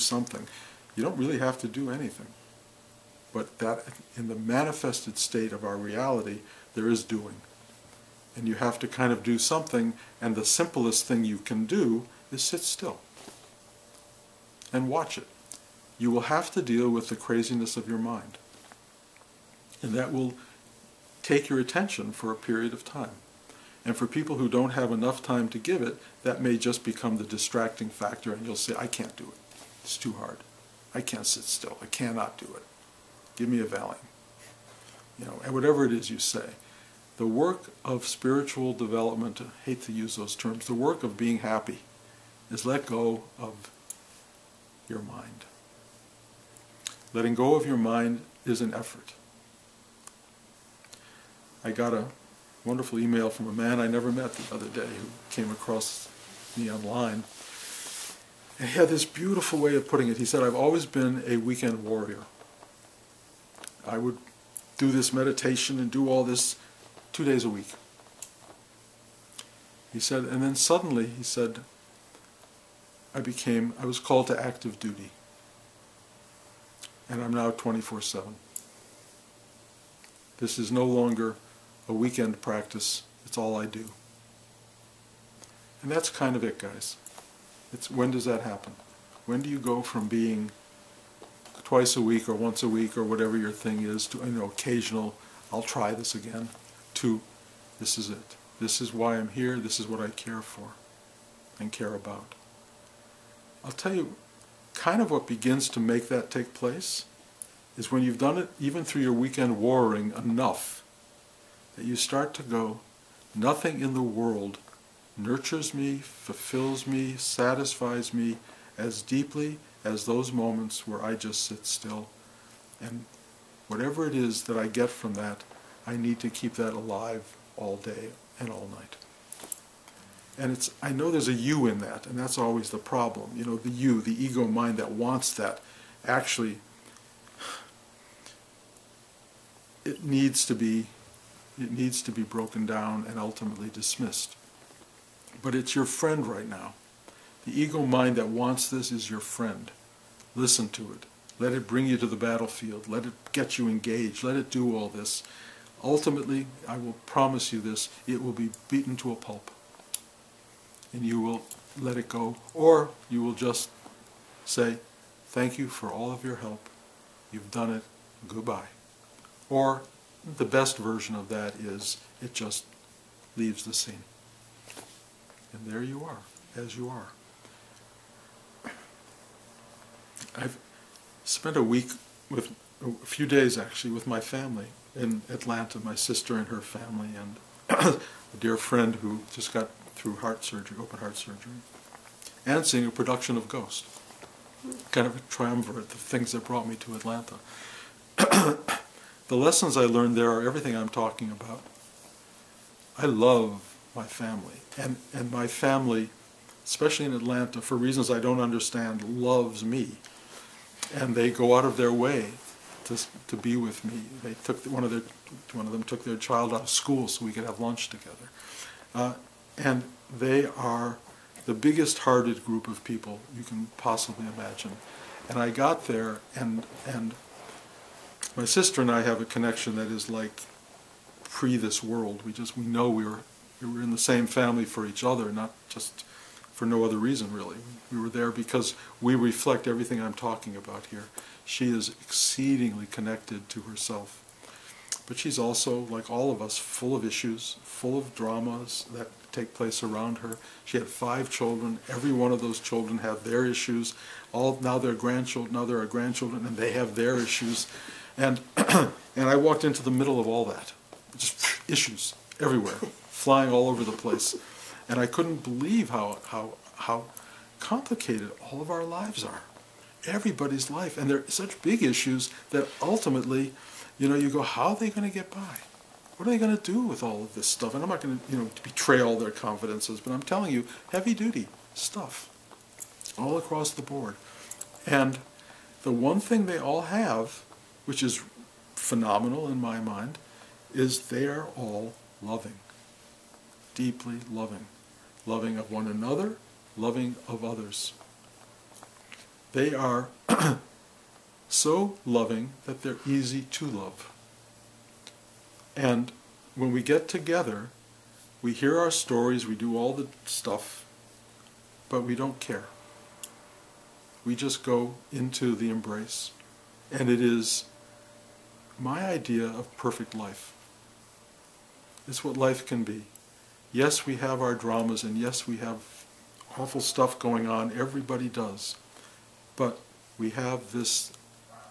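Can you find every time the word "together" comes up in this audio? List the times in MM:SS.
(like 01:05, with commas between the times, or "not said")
03:37, 05:07.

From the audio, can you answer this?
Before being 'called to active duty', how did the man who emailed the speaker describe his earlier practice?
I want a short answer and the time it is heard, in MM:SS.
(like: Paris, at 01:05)
weekend warrior, at 01:01.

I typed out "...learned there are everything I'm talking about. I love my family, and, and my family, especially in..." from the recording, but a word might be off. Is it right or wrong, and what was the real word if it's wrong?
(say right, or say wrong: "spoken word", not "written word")
right.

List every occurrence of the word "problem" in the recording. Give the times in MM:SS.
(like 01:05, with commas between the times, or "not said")
02:12.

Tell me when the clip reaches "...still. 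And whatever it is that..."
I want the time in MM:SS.
02:01.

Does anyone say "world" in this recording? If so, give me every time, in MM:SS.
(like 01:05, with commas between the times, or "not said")
01:53, 03:51.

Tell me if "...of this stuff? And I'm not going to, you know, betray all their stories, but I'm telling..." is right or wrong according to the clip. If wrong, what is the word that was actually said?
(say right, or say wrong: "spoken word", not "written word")
wrong: "confidences", not "stories".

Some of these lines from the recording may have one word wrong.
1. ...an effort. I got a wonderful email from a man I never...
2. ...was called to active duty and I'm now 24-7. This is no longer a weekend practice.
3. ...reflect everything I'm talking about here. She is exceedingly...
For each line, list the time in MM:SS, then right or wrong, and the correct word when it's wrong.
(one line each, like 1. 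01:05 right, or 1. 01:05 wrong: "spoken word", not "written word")
1. 00:48 right
2. 01:13 right
3. 03:59 right.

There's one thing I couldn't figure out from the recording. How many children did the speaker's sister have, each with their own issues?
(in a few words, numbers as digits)
5.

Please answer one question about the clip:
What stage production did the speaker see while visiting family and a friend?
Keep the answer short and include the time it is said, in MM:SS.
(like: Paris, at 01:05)
Ghost, at 03:13.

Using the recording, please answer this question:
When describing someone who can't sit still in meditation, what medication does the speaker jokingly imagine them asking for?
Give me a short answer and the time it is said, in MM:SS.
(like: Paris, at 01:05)
Valium, at 00:33.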